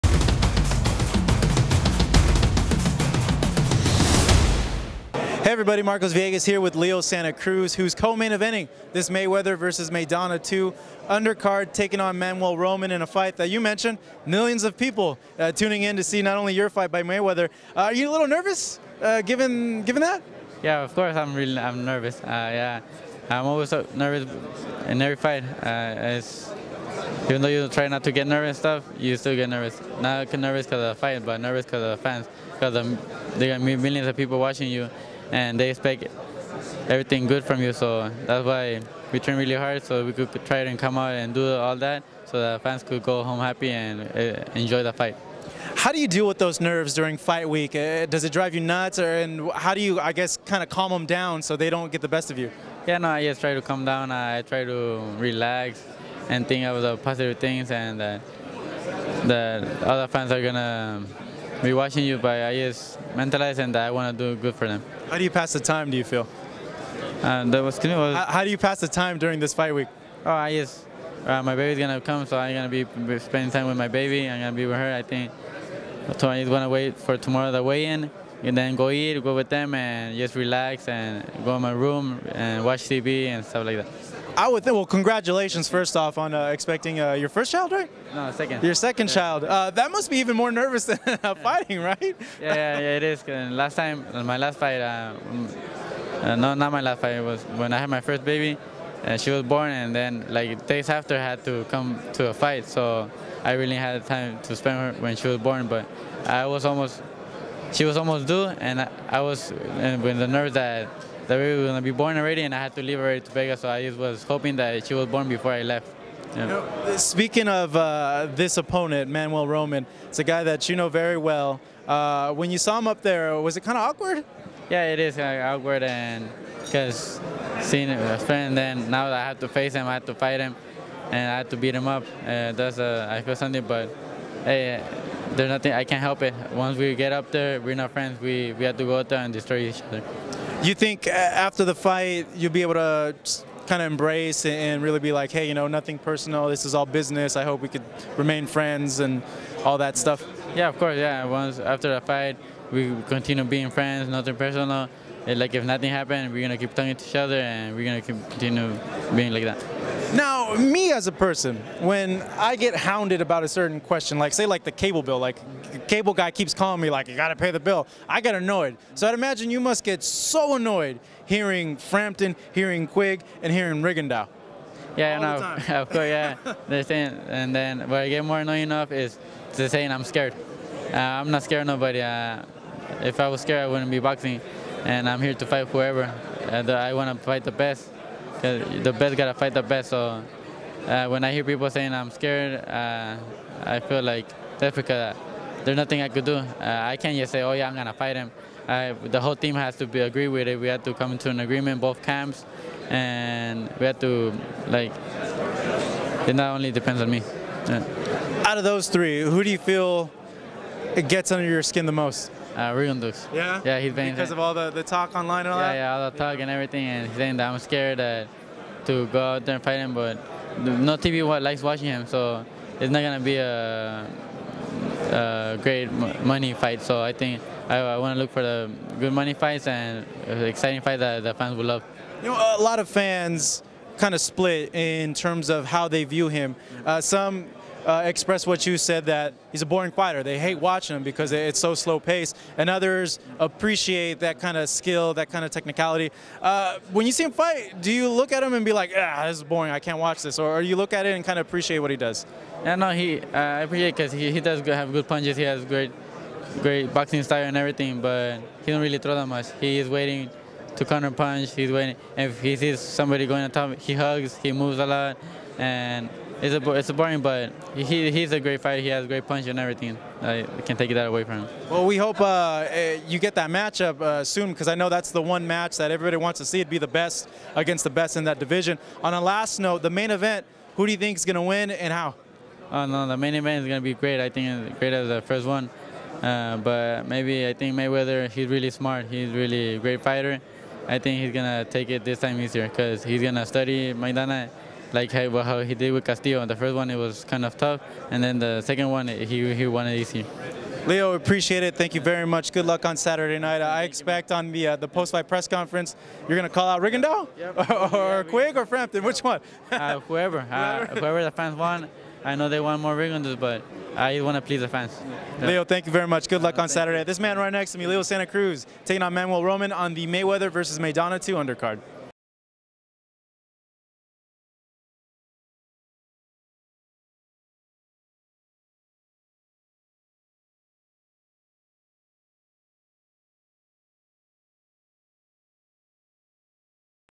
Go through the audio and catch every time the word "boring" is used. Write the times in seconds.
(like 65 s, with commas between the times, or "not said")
239 s, 249 s, 266 s.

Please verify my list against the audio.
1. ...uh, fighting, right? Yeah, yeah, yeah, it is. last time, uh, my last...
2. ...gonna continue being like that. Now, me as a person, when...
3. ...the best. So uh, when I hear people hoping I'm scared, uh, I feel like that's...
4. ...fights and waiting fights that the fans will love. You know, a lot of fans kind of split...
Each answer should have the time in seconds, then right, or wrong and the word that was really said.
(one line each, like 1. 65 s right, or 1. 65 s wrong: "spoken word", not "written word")
1. 91 s right
2. 157 s right
3. 189 s wrong: "saying", not "hoping"
4. 229 s wrong: "exciting", not "waiting".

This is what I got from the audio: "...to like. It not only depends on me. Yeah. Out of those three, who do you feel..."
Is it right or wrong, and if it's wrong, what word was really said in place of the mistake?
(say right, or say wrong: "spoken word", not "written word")
right.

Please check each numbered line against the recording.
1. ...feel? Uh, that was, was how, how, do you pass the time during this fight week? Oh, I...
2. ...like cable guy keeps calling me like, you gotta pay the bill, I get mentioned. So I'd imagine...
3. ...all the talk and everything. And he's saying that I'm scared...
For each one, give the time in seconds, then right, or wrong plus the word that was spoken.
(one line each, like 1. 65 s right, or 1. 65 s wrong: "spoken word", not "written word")
1. 66 s right
2. 165 s wrong: "annoyed", not "mentioned"
3. 215 s right.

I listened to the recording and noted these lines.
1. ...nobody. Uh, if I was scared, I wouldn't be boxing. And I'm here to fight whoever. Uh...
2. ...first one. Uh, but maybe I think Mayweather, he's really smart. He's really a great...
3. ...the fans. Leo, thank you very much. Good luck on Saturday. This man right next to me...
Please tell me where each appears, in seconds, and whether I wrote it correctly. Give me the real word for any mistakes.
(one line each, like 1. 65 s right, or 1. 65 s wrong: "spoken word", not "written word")
1. 181 s right
2. 285 s right
3. 314 s right.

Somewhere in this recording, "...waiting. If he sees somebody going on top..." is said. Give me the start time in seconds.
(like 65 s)
261 s.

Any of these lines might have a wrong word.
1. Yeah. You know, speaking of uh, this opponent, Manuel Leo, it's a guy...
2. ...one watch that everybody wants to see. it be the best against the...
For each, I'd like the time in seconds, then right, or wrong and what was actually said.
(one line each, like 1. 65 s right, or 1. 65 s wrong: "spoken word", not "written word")
1. 116 s wrong: "Roman", not "Leo"
2. 275 s wrong: "match", not "watch".